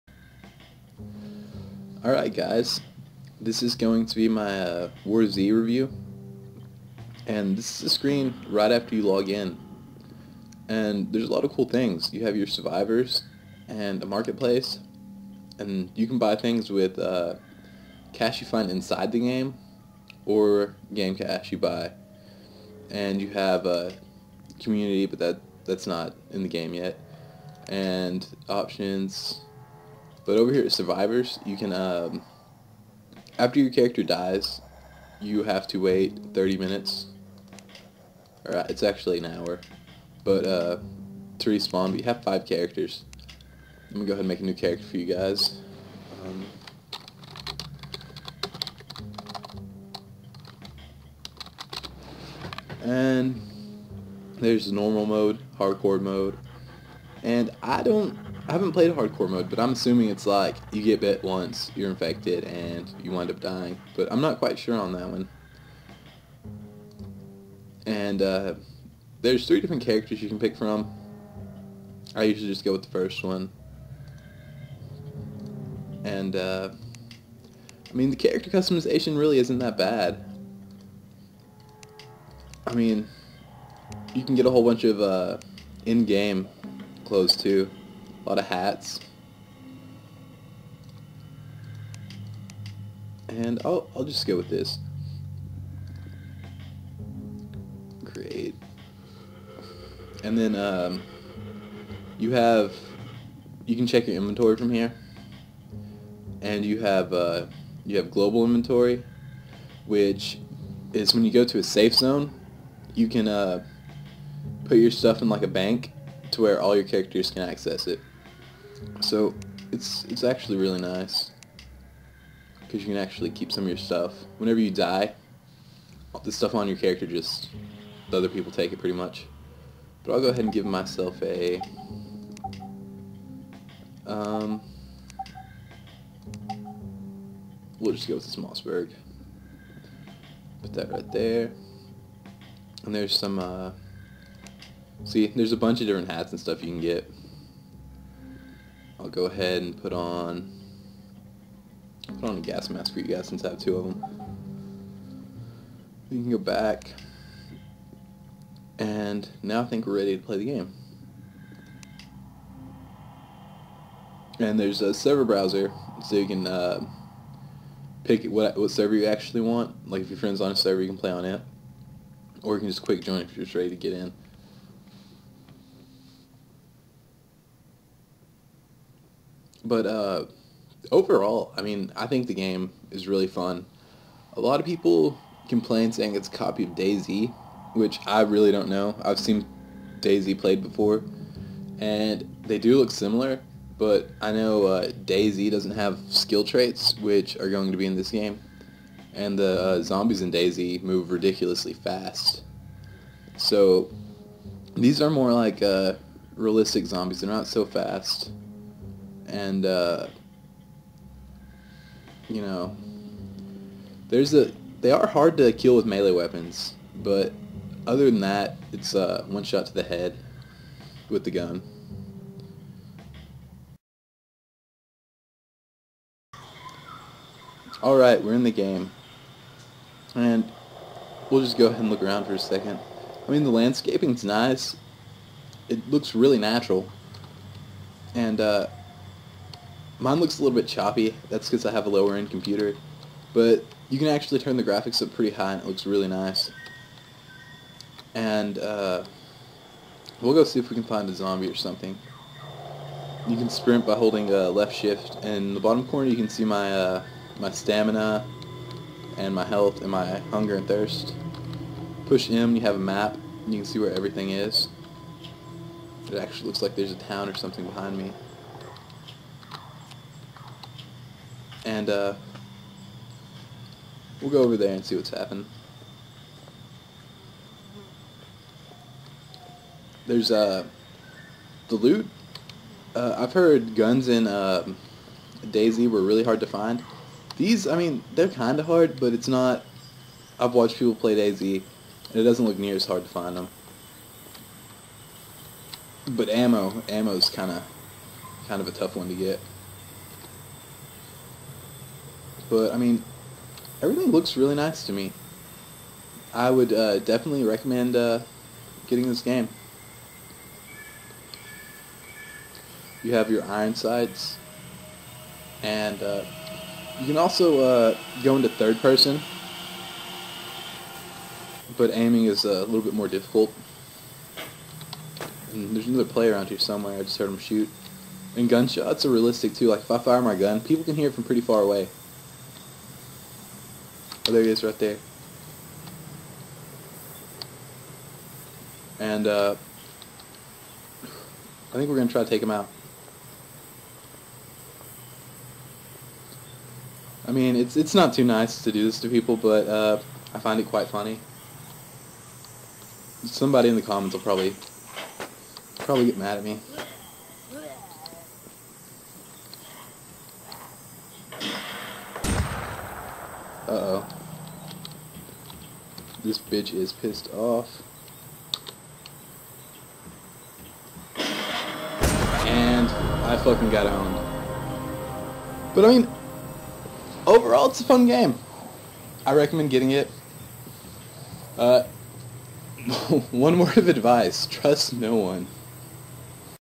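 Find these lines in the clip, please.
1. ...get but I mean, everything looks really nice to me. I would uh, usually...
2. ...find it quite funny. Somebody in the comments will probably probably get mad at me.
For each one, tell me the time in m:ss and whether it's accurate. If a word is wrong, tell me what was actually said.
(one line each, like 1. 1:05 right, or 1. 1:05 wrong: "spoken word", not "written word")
1. 4:59 wrong: "definitely", not "usually"
2. 5:50 right.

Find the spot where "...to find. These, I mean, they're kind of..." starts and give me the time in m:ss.
4:46.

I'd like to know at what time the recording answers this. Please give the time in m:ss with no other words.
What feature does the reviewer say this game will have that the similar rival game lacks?
3:16.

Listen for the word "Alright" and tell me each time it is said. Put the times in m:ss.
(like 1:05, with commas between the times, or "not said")
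0:02, 3:47.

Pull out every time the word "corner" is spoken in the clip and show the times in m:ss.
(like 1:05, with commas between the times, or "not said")
4:15.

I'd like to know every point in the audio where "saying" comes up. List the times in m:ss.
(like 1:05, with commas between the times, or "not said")
3:05.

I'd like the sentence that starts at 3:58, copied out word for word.
And, uh, Mine looks a little bit choppy.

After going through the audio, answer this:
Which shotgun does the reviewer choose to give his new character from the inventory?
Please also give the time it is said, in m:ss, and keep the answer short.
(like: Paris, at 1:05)
Mossberg, at 2:18.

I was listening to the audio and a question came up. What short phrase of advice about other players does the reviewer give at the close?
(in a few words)
trust no one.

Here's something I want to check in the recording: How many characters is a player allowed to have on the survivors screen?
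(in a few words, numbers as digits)
5.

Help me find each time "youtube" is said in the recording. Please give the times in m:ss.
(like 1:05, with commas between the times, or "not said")
not said.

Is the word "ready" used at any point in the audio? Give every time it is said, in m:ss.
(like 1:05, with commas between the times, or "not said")
2:39, 2:53.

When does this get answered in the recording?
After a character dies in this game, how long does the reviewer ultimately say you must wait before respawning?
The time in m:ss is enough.
0:38.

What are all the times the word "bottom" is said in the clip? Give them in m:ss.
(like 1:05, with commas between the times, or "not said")
4:15.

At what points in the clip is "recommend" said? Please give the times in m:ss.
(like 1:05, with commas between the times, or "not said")
5:07, 6:19.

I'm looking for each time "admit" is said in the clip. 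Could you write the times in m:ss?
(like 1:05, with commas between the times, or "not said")
not said.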